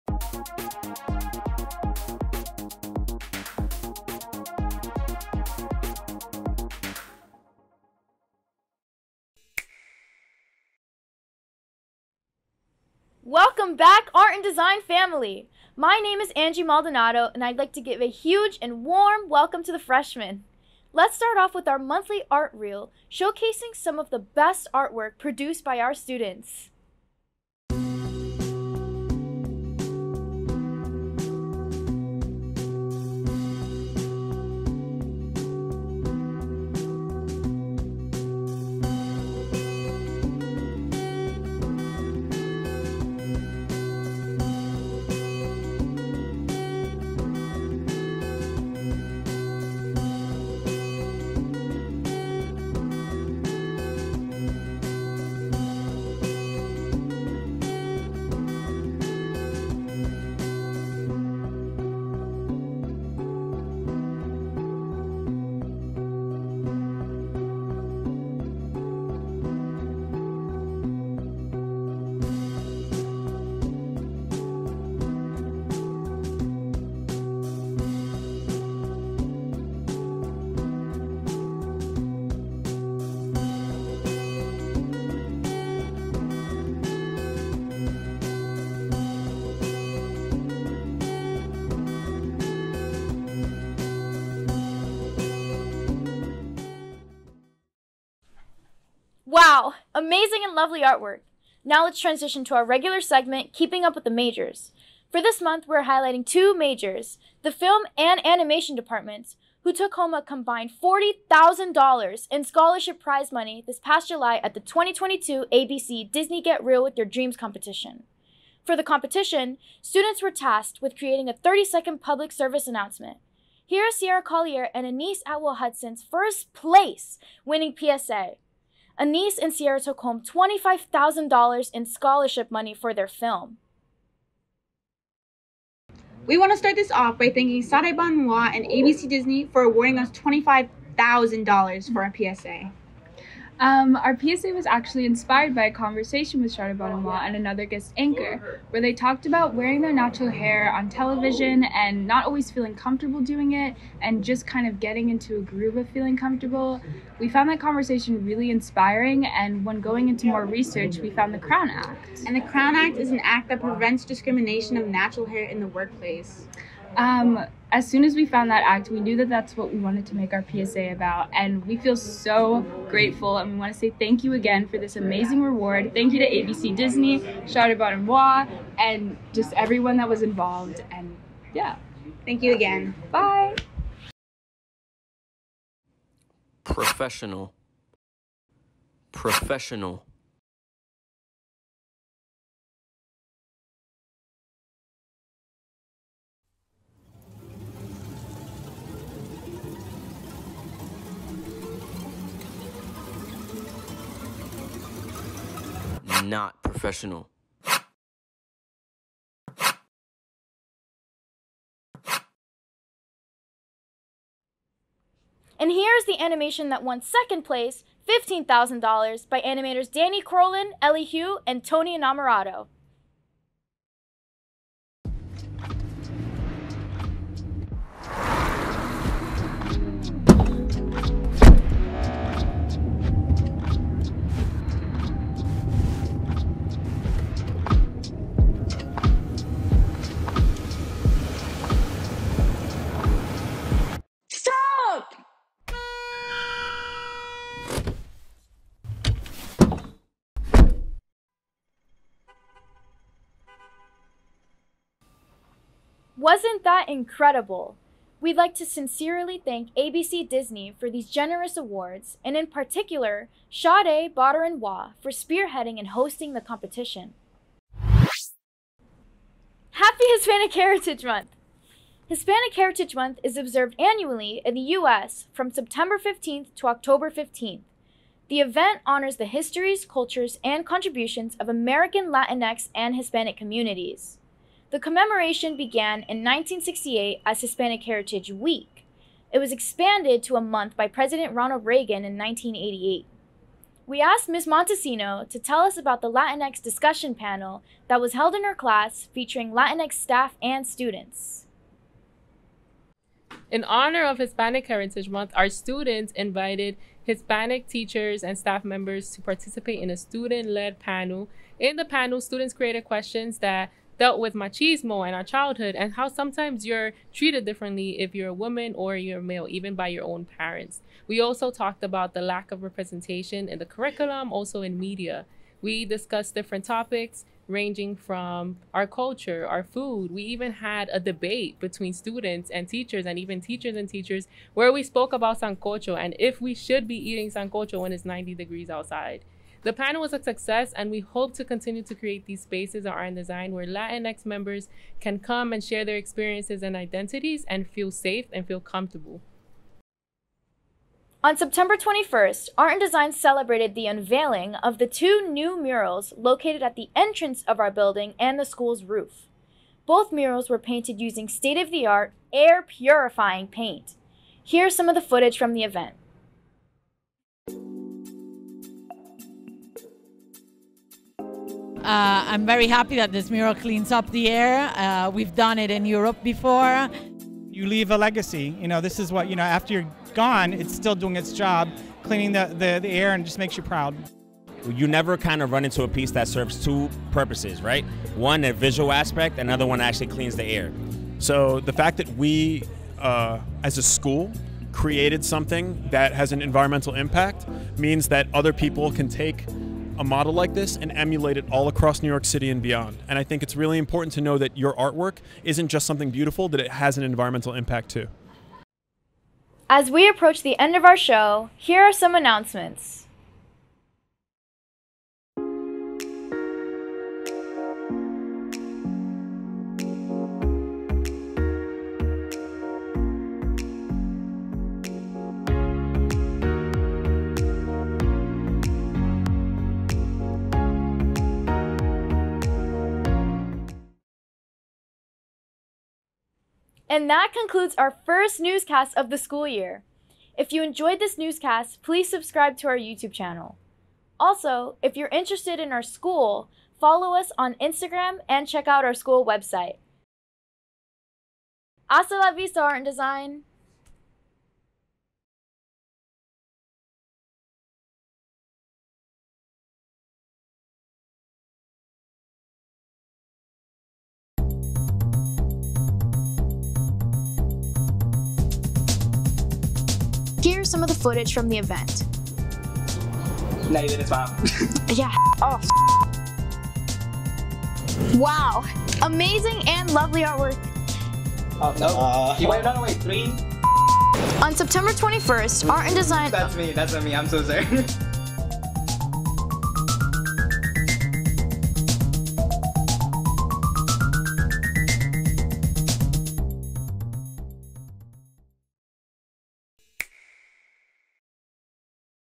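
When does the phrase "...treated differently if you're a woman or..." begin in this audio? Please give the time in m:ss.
5:17.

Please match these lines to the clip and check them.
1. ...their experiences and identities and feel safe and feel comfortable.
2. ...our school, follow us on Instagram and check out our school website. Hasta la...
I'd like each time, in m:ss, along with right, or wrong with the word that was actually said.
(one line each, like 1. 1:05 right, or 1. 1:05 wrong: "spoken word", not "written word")
1. 5:45 right
2. 7:25 right.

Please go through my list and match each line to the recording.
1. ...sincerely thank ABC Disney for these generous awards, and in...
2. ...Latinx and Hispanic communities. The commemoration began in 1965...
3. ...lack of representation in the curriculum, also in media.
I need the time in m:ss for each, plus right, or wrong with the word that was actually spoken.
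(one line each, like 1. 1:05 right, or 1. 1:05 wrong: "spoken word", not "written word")
1. 4:18 right
2. 4:42 wrong: "1968", not "1965"
3. 5:22 right.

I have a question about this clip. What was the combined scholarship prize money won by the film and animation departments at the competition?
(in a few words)
$40,000.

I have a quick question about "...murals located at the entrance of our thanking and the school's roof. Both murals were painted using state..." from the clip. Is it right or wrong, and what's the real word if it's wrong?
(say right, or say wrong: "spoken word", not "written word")
wrong: "building", not "thanking".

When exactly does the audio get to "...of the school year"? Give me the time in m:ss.
7:18.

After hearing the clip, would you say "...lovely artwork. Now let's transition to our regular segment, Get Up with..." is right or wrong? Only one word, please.
wrong.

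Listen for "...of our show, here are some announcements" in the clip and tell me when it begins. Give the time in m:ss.
6:50.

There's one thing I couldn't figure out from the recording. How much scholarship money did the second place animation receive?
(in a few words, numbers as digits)
$15,000.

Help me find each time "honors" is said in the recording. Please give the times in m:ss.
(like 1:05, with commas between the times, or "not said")
4:38, 5:03.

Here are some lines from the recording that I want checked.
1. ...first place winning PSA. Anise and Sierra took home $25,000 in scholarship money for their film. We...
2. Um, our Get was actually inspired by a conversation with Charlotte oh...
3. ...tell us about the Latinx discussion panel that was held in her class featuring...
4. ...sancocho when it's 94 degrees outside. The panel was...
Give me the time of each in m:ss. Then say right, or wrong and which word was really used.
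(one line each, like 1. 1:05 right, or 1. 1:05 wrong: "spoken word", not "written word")
1. 2:06 right
2. 2:23 wrong: "PSA", not "Get"
3. 4:55 right
4. 5:37 wrong: "90", not "94".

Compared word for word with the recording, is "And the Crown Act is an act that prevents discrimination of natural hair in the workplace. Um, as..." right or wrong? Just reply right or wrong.
right.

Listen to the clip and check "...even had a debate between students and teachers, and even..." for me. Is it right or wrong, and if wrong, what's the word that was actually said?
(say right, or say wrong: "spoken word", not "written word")
right.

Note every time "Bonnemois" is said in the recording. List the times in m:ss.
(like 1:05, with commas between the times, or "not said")
2:26, 2:57.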